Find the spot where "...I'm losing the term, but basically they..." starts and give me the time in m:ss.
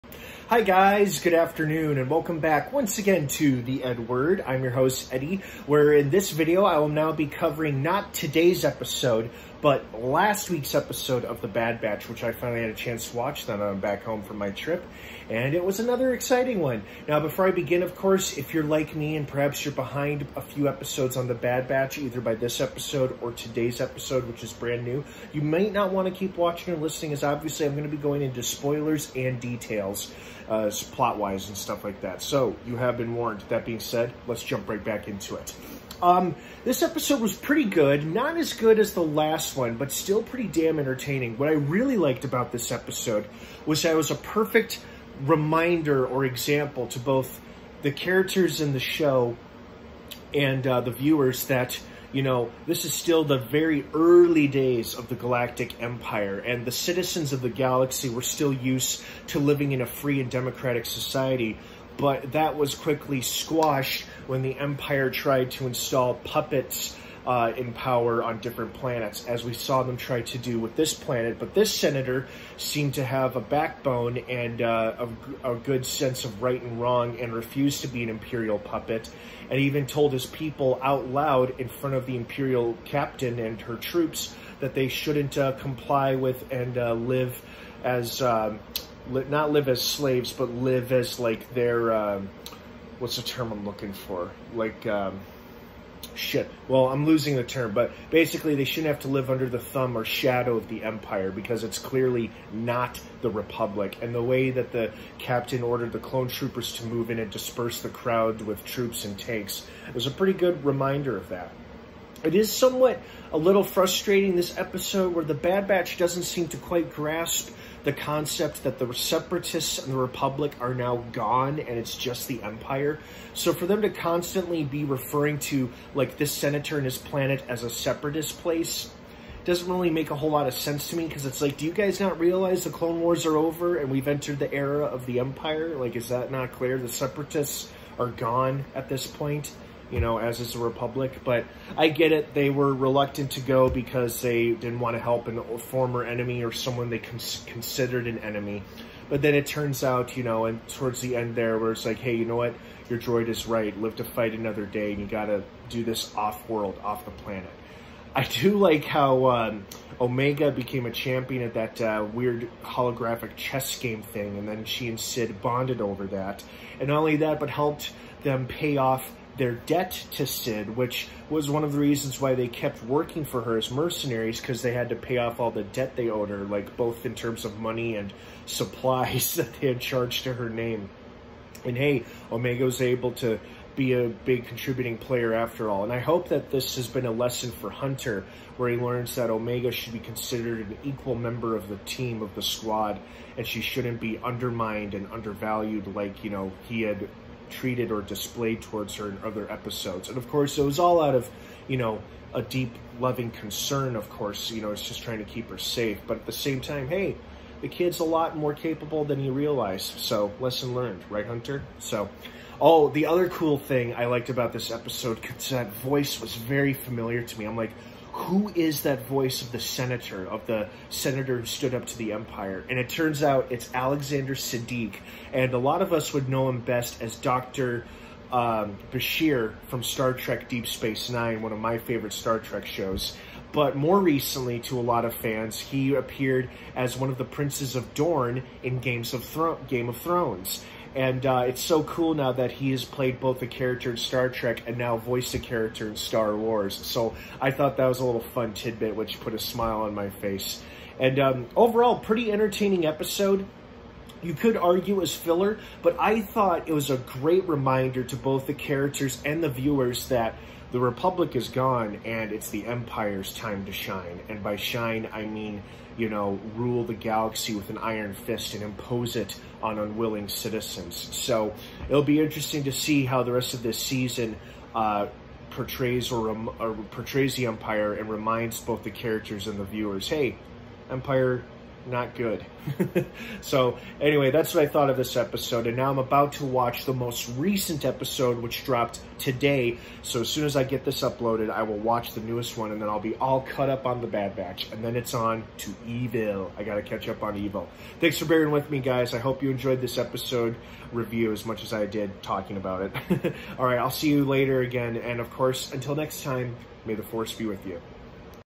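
1:36.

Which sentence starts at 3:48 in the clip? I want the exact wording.
Um, Bashir from Star Trek Deep Space Nine, one of my favorite Star Trek shows.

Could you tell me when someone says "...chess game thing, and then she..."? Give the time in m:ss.
2:43.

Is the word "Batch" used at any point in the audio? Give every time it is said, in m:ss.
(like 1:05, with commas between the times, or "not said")
0:11, 0:21, 1:55, 4:54.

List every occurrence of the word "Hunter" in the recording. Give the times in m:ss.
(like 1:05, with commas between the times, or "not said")
3:07, 3:31.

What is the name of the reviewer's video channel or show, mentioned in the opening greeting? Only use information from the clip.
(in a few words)
The EdWord.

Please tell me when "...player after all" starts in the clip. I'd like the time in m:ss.
3:04.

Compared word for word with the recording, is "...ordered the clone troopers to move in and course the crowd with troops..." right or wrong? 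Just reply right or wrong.
wrong.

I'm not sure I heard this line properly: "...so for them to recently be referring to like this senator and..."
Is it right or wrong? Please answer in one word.
wrong.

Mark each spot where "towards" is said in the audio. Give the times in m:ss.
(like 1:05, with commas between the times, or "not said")
2:30, 3:18.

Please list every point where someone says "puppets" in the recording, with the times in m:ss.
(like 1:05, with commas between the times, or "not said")
1:06, 1:18.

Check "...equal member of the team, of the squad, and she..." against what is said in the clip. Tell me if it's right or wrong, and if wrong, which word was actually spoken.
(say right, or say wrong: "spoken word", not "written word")
right.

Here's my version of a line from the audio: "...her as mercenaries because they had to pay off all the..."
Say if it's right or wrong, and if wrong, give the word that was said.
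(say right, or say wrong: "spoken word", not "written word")
right.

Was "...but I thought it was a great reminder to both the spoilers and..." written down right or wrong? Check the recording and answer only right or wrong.
wrong.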